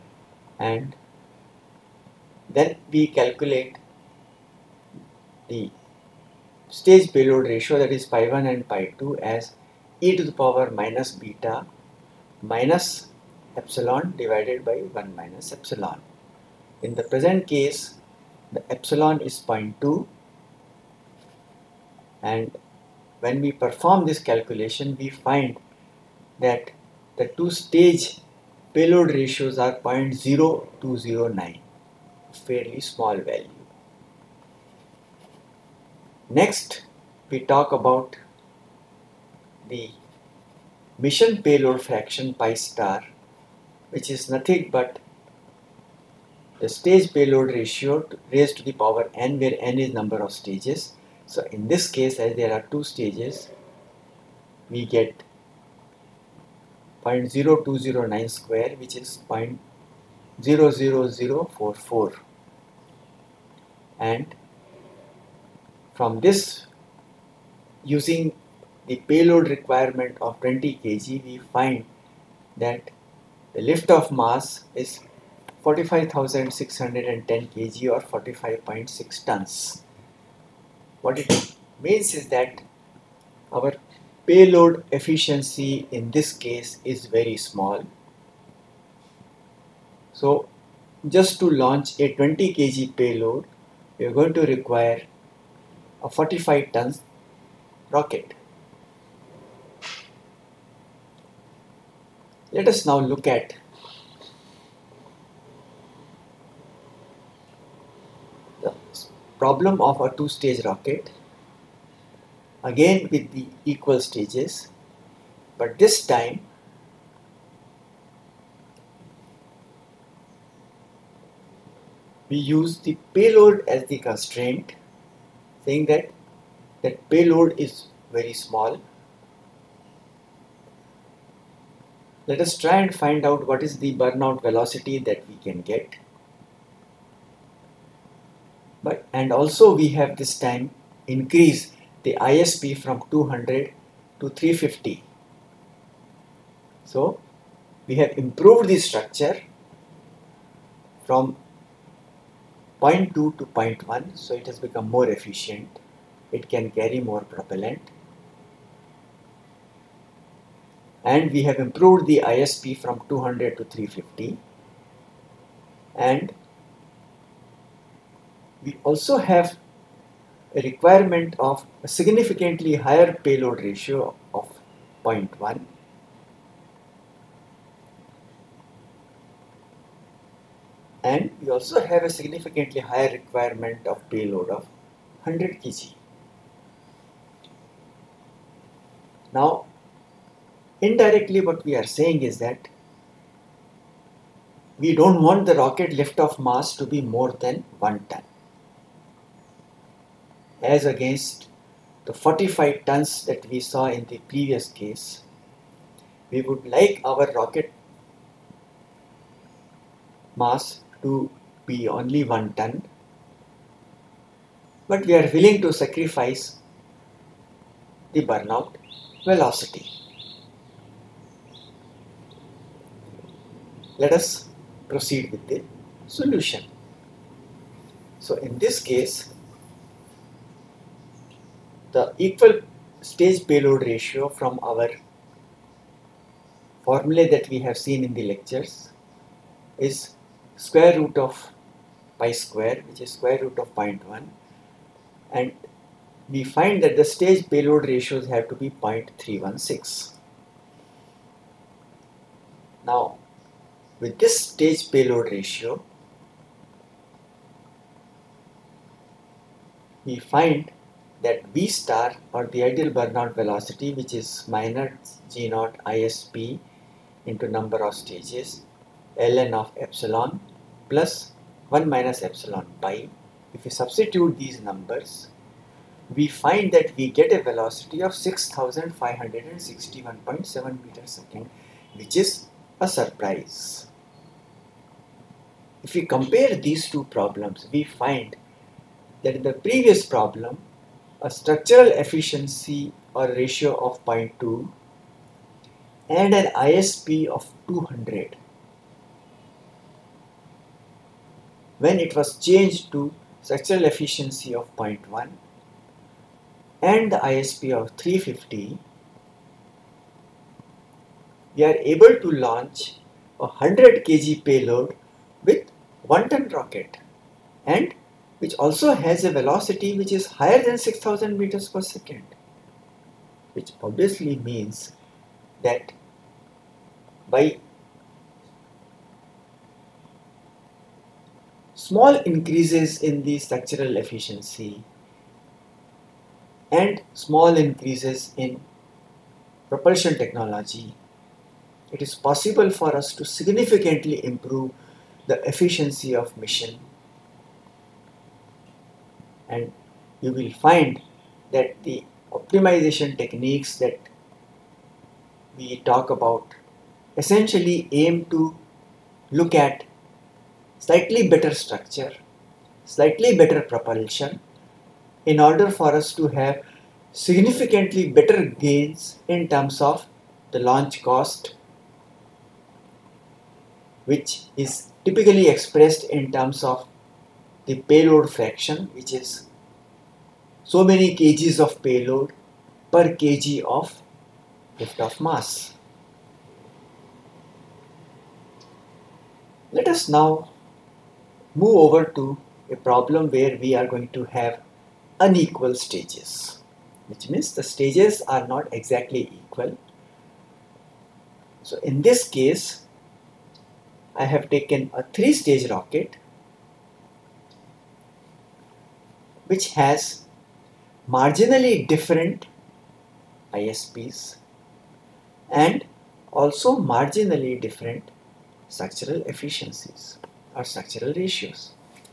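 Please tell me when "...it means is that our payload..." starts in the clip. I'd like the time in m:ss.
1:21.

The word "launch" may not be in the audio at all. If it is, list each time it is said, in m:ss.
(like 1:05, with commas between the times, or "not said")
1:31, 5:12, 6:10.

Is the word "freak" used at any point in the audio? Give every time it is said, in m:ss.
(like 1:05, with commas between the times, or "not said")
not said.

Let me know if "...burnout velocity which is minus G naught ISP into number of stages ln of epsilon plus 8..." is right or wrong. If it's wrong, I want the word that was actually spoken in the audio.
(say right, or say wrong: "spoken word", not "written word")
wrong: "1", not "8".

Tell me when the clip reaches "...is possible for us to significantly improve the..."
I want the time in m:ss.
5:42.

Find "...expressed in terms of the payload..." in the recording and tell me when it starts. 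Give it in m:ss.
6:15.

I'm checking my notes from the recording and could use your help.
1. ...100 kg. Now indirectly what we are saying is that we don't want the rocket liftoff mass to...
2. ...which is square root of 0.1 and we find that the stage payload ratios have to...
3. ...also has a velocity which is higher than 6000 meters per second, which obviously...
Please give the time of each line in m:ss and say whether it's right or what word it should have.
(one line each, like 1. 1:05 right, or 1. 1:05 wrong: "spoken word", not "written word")
1. 3:05 right
2. 4:02 right
3. 5:18 right.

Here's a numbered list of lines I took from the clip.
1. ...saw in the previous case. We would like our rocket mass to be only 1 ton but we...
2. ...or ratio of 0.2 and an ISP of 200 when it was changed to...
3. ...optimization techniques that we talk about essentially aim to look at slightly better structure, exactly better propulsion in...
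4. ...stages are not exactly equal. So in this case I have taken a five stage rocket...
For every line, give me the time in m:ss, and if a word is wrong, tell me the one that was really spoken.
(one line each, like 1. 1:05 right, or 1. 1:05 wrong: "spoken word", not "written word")
1. 3:23 right
2. 4:53 right
3. 5:52 wrong: "slightly", not "exactly"
4. 6:37 wrong: "three", not "five".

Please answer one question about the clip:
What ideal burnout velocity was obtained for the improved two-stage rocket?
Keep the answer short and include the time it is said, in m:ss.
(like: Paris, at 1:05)
6561.7 m/s, at 4:38.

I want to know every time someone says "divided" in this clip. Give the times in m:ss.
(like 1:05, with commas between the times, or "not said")
0:14.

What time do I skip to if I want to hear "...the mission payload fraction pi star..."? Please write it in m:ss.
0:39.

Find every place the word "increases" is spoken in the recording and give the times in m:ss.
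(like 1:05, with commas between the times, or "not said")
2:21, 5:32, 5:37.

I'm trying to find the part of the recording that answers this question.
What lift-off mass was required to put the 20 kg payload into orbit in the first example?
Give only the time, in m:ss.
1:15.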